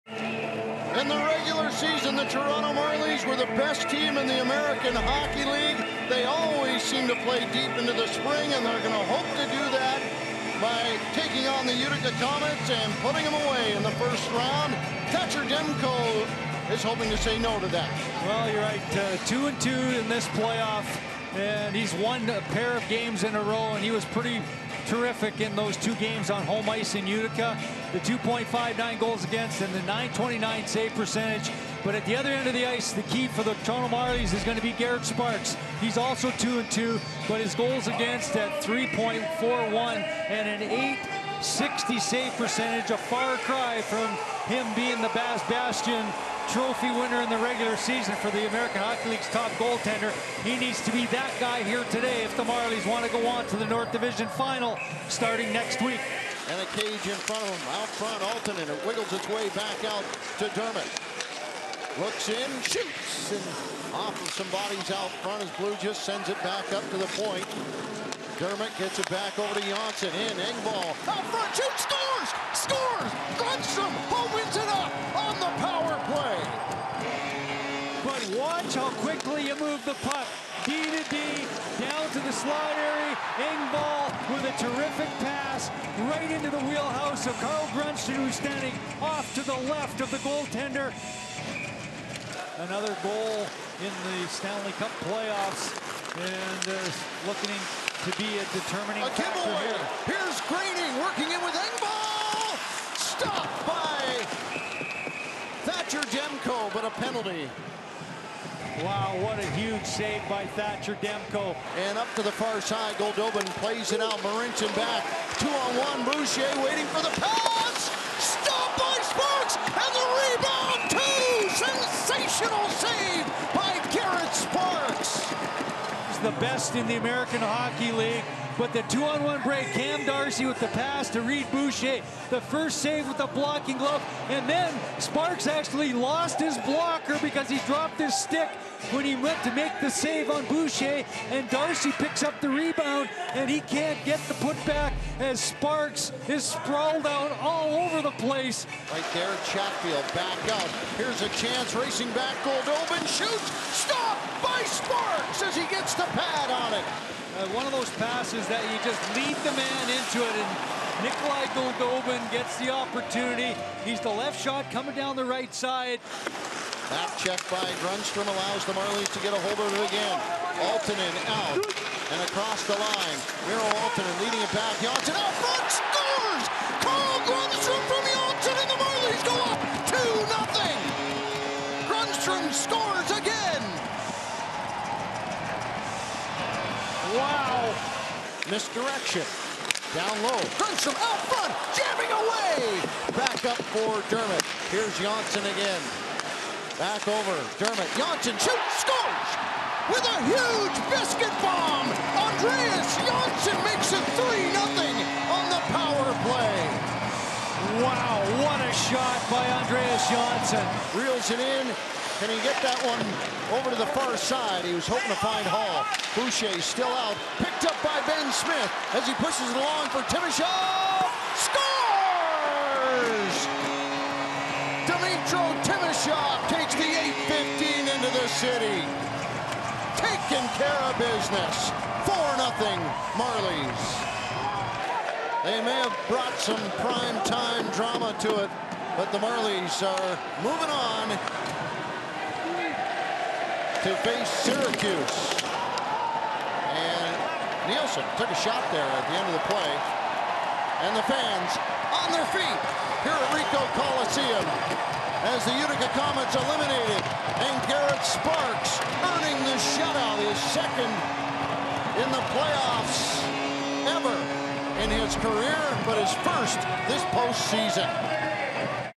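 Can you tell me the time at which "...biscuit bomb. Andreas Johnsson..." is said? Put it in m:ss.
3:20.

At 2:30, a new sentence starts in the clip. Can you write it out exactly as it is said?
Here's a chance, racing back, Goldobin shoots, stopped by Sparks as he gets the pad on it.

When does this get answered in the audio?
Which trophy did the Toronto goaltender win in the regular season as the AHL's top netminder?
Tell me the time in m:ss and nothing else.
0:45.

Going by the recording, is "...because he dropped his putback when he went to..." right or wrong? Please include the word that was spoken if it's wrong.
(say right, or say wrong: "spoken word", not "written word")
wrong: "stick", not "putback".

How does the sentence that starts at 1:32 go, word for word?
Another goal in the Stanley Cup playoffs and uh, looking to be a determining a factor here.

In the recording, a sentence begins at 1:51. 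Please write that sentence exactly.
And up to the far side, Goldobin plays it out.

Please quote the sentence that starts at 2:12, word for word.
The first save with the blocking glove.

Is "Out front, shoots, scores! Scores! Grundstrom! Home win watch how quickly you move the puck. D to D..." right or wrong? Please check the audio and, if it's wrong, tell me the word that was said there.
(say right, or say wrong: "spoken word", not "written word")
right.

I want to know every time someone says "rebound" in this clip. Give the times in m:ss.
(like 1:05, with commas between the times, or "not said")
2:00, 2:22.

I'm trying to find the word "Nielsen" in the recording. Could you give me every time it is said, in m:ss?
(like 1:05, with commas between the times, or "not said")
4:07.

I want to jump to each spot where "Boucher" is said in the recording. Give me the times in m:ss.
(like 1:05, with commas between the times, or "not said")
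1:56, 2:11, 2:20, 3:36.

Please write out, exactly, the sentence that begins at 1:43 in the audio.
Stopped by Thatcher Demko, but a penalty.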